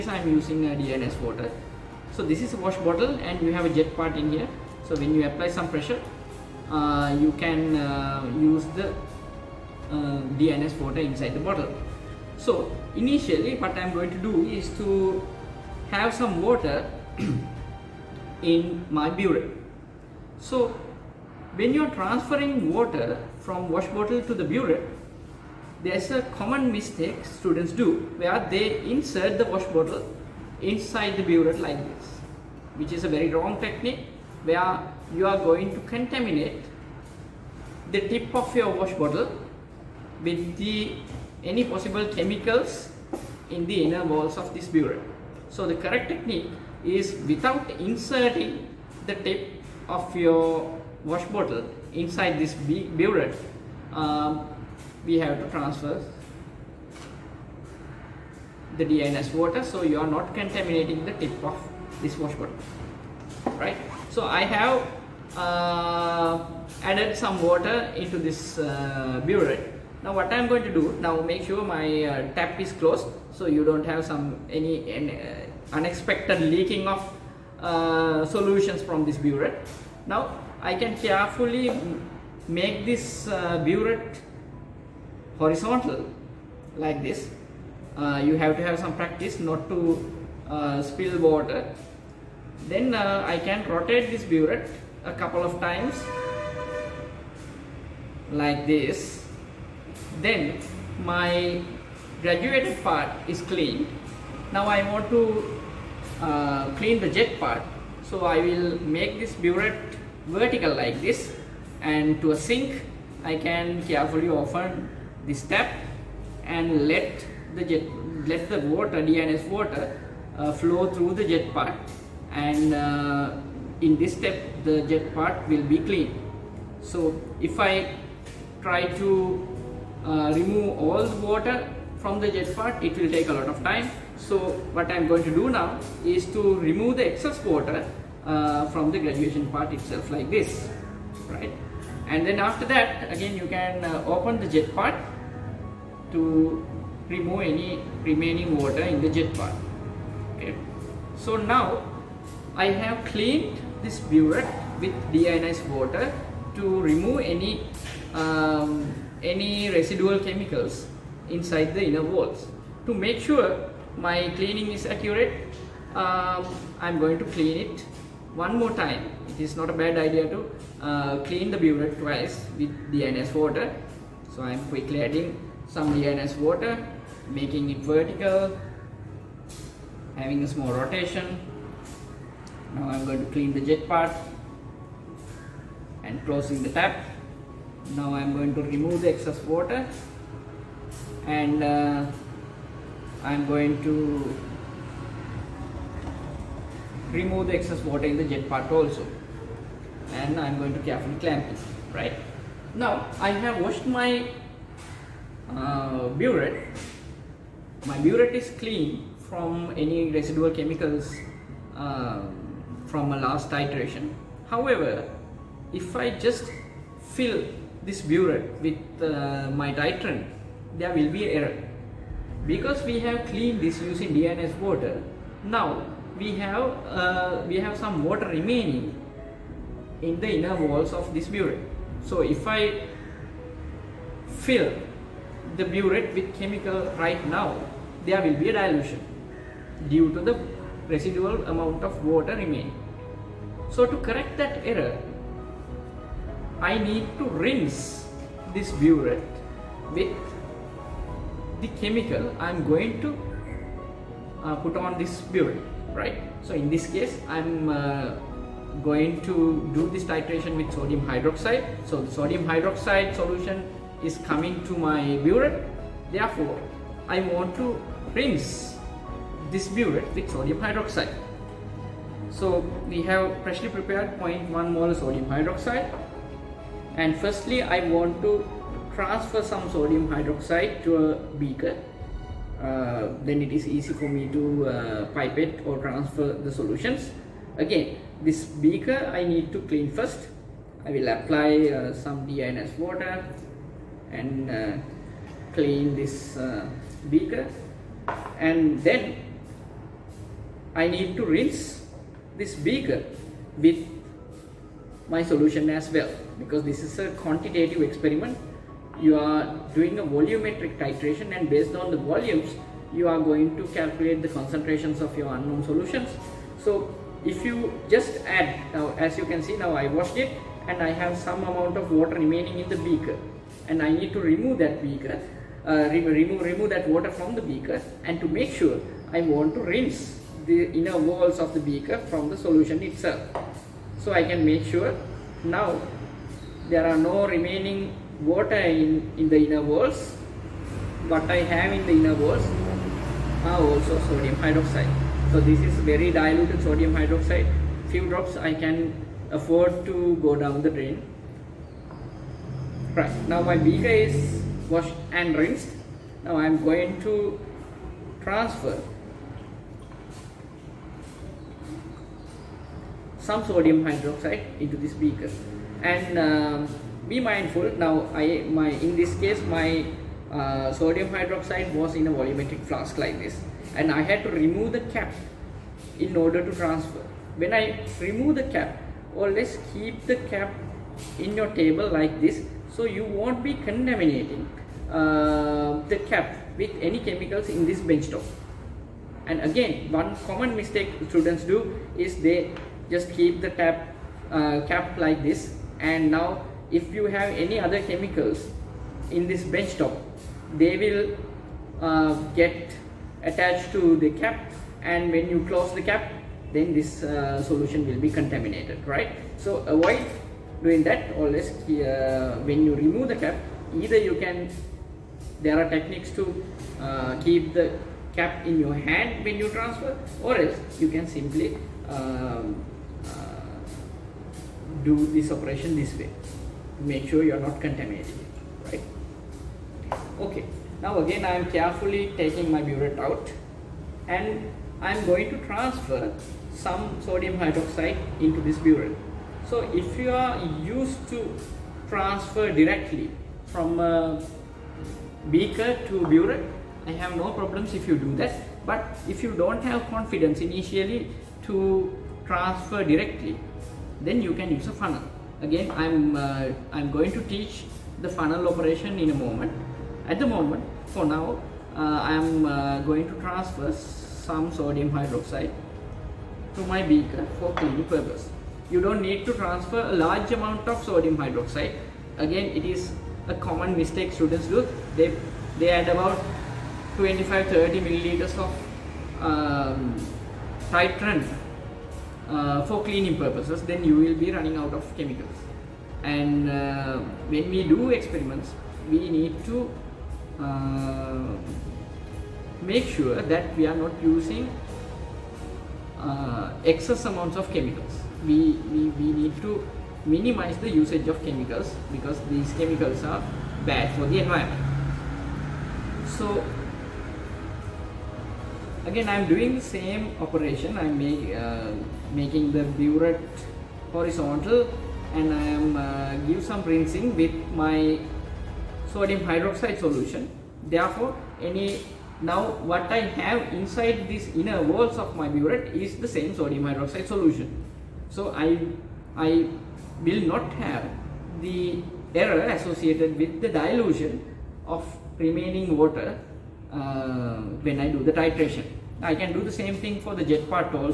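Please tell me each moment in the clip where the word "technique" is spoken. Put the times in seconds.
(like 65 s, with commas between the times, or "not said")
33 s, 46 s, 415 s.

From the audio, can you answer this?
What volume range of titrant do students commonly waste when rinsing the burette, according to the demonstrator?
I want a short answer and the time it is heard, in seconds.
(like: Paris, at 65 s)
25 to 30 milliliters, at 476 s.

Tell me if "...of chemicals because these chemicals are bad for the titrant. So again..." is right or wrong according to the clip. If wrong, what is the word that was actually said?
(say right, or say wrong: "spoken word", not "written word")
wrong: "environment", not "titrant".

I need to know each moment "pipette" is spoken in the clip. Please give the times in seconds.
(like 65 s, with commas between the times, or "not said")
285 s.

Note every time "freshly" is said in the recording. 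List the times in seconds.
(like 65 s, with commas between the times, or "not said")
273 s.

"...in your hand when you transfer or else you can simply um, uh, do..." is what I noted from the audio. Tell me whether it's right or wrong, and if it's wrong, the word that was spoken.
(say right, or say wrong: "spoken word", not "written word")
right.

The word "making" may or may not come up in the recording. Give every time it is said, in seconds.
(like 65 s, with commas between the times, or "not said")
177 s, 512 s.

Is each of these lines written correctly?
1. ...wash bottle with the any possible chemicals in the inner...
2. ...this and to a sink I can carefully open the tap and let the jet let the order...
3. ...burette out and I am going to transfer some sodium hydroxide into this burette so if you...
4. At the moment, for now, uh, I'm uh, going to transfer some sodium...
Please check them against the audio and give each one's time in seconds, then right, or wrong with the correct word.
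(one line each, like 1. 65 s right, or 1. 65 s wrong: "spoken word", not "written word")
1. 38 s right
2. 111 s wrong: "water", not "order"
3. 432 s right
4. 460 s right.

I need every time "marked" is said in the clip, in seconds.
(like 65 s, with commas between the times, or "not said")
not said.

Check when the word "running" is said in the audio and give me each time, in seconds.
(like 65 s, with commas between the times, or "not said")
484 s.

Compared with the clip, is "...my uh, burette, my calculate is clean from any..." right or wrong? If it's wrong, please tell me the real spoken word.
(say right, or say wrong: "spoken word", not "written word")
wrong: "burette", not "calculate".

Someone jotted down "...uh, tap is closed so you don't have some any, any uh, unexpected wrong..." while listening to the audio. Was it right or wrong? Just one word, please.
wrong.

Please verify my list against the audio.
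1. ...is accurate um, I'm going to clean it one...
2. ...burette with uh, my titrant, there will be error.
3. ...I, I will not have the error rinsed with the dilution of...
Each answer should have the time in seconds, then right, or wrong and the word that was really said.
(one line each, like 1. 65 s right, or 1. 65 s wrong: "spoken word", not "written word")
1. 164 s right
2. 218 s right
3. 528 s wrong: "associated", not "rinsed".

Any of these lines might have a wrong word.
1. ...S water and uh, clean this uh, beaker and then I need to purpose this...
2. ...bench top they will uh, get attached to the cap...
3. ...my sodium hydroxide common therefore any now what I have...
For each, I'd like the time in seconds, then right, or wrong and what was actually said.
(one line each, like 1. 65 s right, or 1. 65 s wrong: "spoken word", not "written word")
1. 292 s wrong: "rinse", not "purpose"
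2. 399 s right
3. 517 s wrong: "solution", not "common".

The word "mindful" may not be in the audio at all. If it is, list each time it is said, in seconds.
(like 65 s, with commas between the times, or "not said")
367 s.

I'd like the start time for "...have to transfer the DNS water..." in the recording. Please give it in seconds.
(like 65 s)
55 s.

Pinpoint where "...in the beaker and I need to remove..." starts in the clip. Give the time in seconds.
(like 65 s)
322 s.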